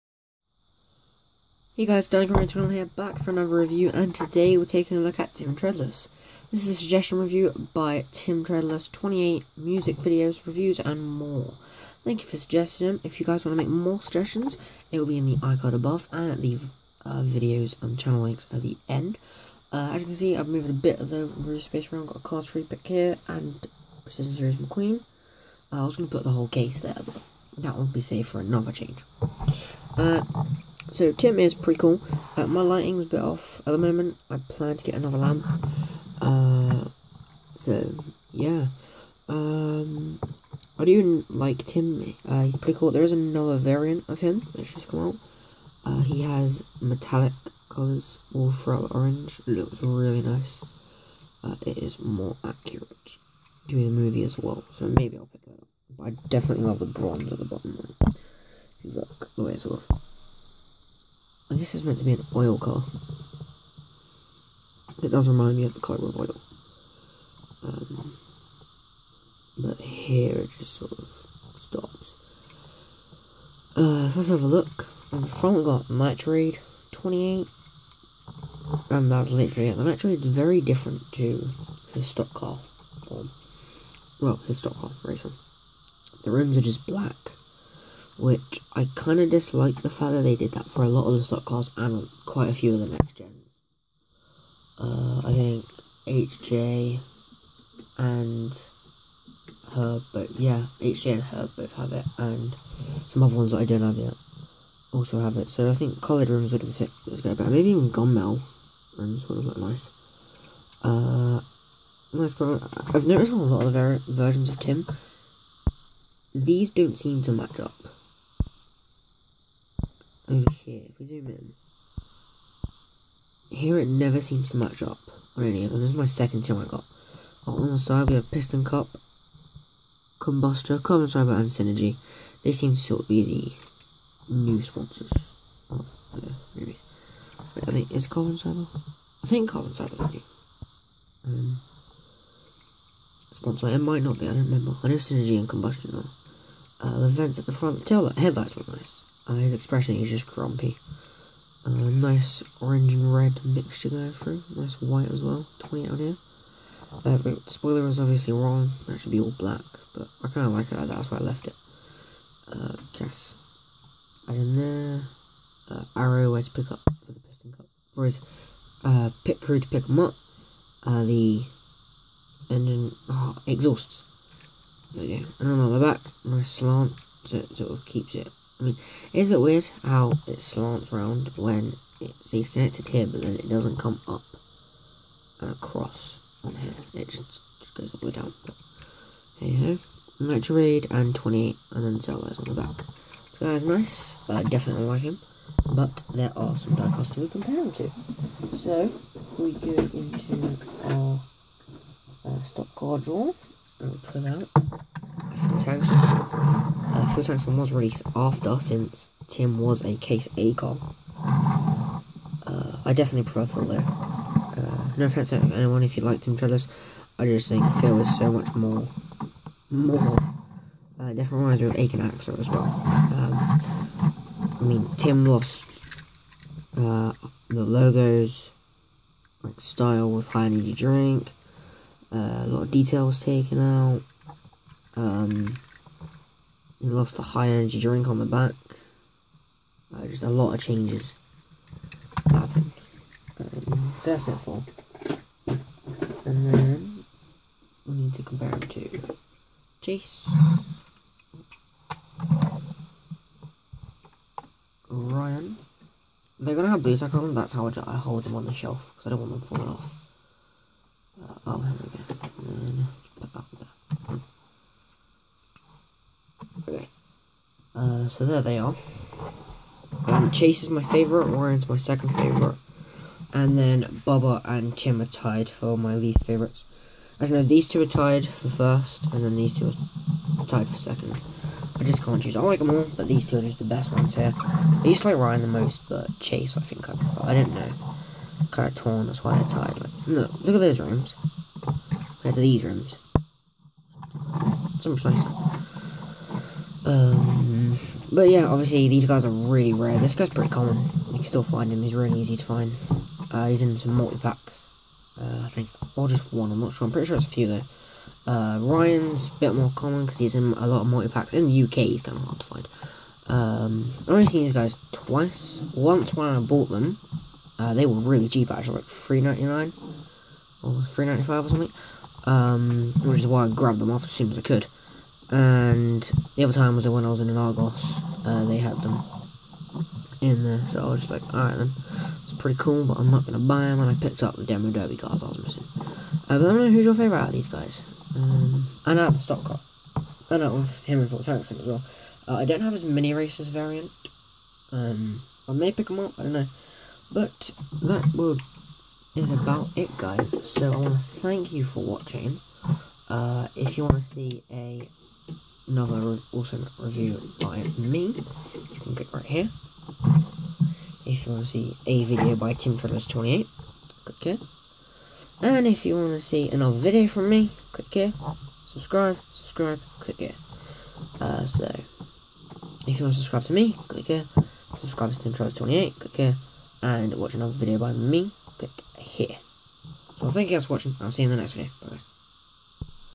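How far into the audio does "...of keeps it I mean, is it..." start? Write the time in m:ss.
2:57.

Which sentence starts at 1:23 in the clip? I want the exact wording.
Or, well, his stock car racer.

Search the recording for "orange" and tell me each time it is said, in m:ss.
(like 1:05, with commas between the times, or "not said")
0:48, 2:32.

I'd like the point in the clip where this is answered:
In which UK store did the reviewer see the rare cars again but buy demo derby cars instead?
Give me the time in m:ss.
5:27.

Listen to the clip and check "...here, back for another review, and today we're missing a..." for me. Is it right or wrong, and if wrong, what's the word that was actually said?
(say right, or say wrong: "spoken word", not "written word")
wrong: "taking", not "missing".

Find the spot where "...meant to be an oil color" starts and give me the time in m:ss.
1:01.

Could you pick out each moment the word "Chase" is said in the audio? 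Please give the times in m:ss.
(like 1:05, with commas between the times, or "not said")
4:09, 4:30, 4:46.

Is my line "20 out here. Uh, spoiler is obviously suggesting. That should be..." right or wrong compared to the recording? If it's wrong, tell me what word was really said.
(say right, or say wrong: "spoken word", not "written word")
wrong: "wrong", not "suggesting".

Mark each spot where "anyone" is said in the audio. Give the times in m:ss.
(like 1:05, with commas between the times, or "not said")
3:35.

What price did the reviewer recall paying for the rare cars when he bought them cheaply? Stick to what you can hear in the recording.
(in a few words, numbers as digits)
3.99.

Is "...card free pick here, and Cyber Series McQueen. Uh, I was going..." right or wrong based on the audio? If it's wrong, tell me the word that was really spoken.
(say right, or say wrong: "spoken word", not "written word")
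wrong: "Precision", not "Cyber".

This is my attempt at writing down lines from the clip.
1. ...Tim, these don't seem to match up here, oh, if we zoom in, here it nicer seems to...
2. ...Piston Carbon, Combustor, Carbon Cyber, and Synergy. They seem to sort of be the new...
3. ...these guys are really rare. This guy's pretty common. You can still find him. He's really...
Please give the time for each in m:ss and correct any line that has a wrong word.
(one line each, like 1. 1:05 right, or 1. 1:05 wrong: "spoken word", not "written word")
1. 1:54 wrong: "never", not "nicer"
2. 2:08 wrong: "Cup", not "Carbon"
3. 4:58 right.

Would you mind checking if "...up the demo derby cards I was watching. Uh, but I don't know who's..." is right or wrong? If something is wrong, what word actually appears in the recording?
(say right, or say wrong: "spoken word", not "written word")
wrong: "missing", not "watching".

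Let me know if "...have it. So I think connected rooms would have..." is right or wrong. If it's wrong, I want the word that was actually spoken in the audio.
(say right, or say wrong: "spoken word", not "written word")
wrong: "coloured", not "connected".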